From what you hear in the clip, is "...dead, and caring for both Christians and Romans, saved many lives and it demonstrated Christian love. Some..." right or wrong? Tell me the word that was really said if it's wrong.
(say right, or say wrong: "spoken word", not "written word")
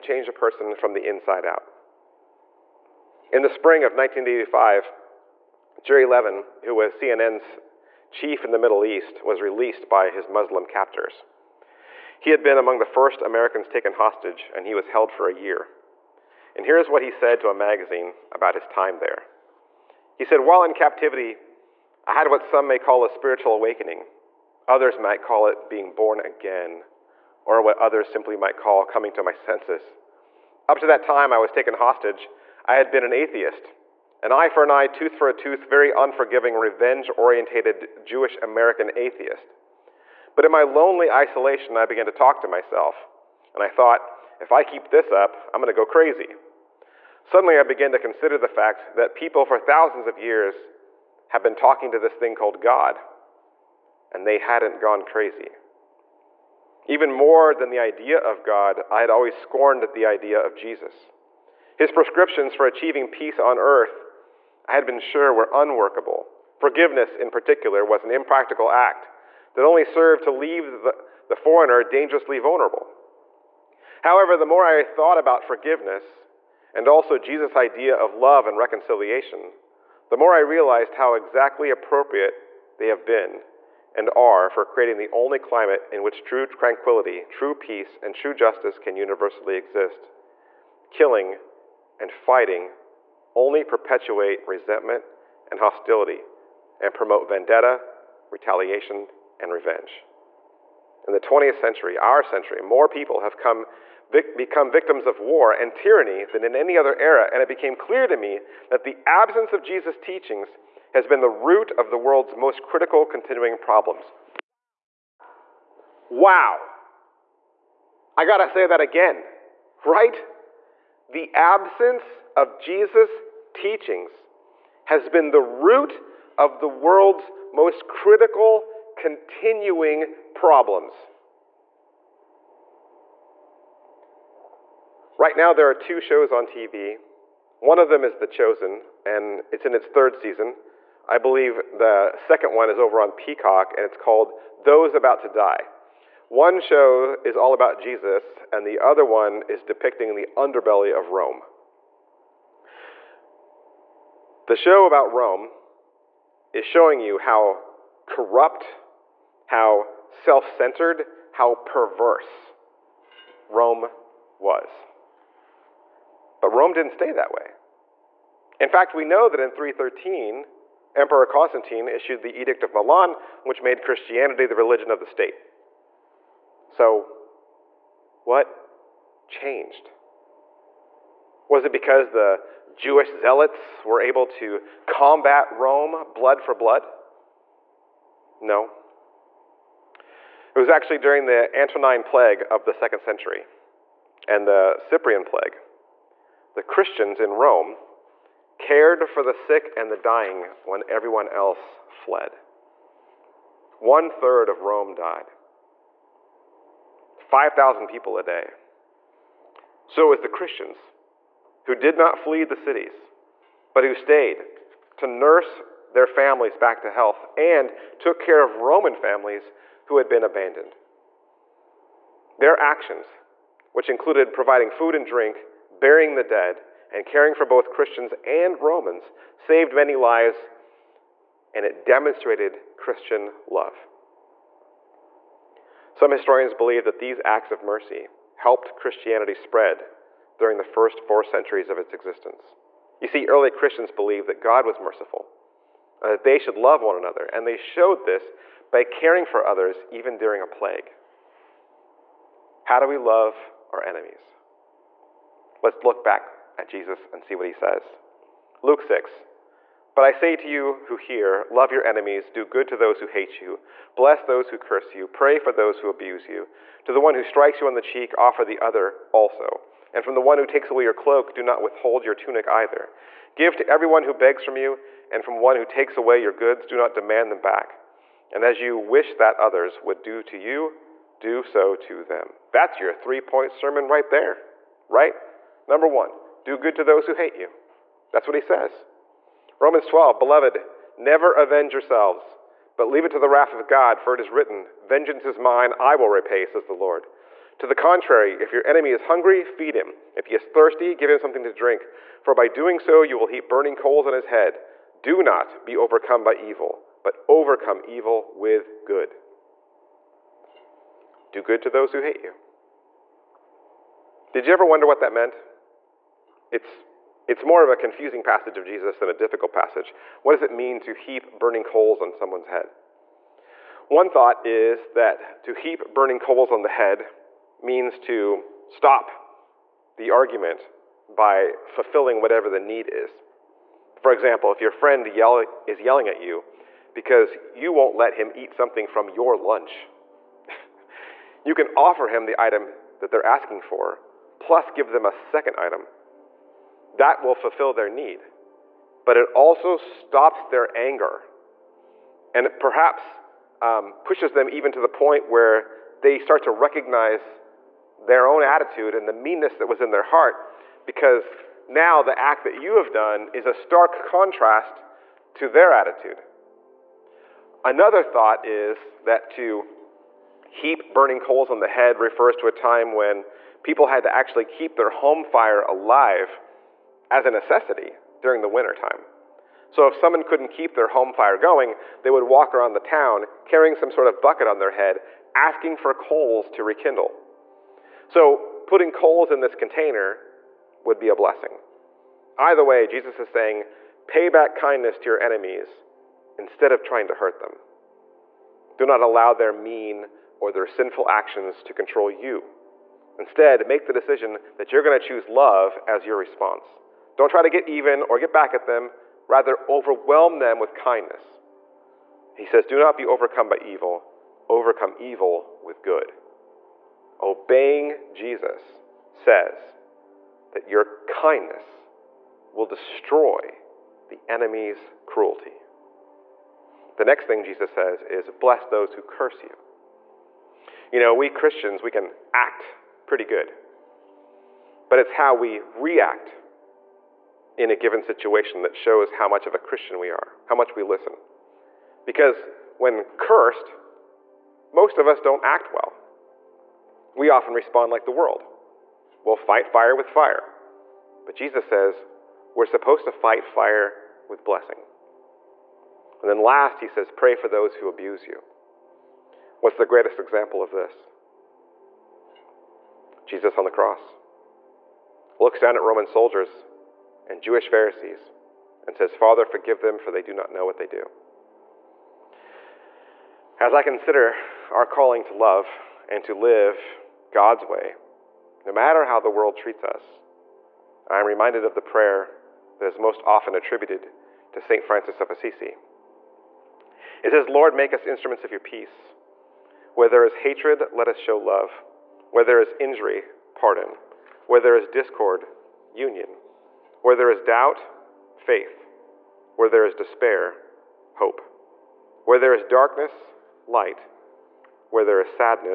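right.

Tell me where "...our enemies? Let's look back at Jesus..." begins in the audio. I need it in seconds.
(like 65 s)
253 s.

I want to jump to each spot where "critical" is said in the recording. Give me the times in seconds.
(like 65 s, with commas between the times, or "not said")
112 s, 127 s.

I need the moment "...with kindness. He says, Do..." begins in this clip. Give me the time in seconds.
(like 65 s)
410 s.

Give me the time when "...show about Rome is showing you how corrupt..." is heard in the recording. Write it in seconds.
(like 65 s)
154 s.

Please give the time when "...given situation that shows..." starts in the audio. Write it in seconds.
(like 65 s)
437 s.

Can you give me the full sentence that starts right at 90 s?
Killing and fighting only perpetuate resentment and hostility and promote vendetta, retaliation, and revenge.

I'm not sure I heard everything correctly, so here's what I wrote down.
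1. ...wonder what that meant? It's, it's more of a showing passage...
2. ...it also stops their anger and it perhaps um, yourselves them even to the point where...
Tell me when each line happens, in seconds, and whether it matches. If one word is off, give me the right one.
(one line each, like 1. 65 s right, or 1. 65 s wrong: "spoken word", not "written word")
1. 314 s wrong: "confusing", not "showing"
2. 349 s wrong: "pushes", not "yourselves".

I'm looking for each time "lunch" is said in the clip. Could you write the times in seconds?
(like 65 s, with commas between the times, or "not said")
339 s.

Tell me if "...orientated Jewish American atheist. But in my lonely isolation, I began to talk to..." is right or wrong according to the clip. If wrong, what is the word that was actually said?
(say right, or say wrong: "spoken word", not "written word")
right.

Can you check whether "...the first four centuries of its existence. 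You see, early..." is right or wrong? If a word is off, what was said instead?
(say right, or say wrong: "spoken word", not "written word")
right.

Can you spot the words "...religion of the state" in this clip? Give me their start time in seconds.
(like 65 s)
174 s.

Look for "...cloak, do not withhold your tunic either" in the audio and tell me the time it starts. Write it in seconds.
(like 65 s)
270 s.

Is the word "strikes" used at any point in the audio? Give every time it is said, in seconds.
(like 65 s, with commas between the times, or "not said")
267 s.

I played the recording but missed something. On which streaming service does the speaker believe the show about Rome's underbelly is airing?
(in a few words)
Peacock.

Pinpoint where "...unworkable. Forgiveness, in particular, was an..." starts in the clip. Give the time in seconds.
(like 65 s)
65 s.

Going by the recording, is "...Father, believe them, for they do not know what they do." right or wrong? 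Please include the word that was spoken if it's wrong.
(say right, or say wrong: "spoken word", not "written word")
wrong: "forgive", not "believe".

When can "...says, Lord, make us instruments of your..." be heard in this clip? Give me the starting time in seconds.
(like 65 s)
487 s.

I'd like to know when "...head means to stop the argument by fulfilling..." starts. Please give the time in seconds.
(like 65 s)
326 s.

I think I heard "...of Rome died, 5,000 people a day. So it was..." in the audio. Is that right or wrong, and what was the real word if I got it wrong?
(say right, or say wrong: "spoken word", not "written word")
right.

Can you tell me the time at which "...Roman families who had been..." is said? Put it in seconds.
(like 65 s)
218 s.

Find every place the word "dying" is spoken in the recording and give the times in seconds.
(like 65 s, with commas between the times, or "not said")
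199 s.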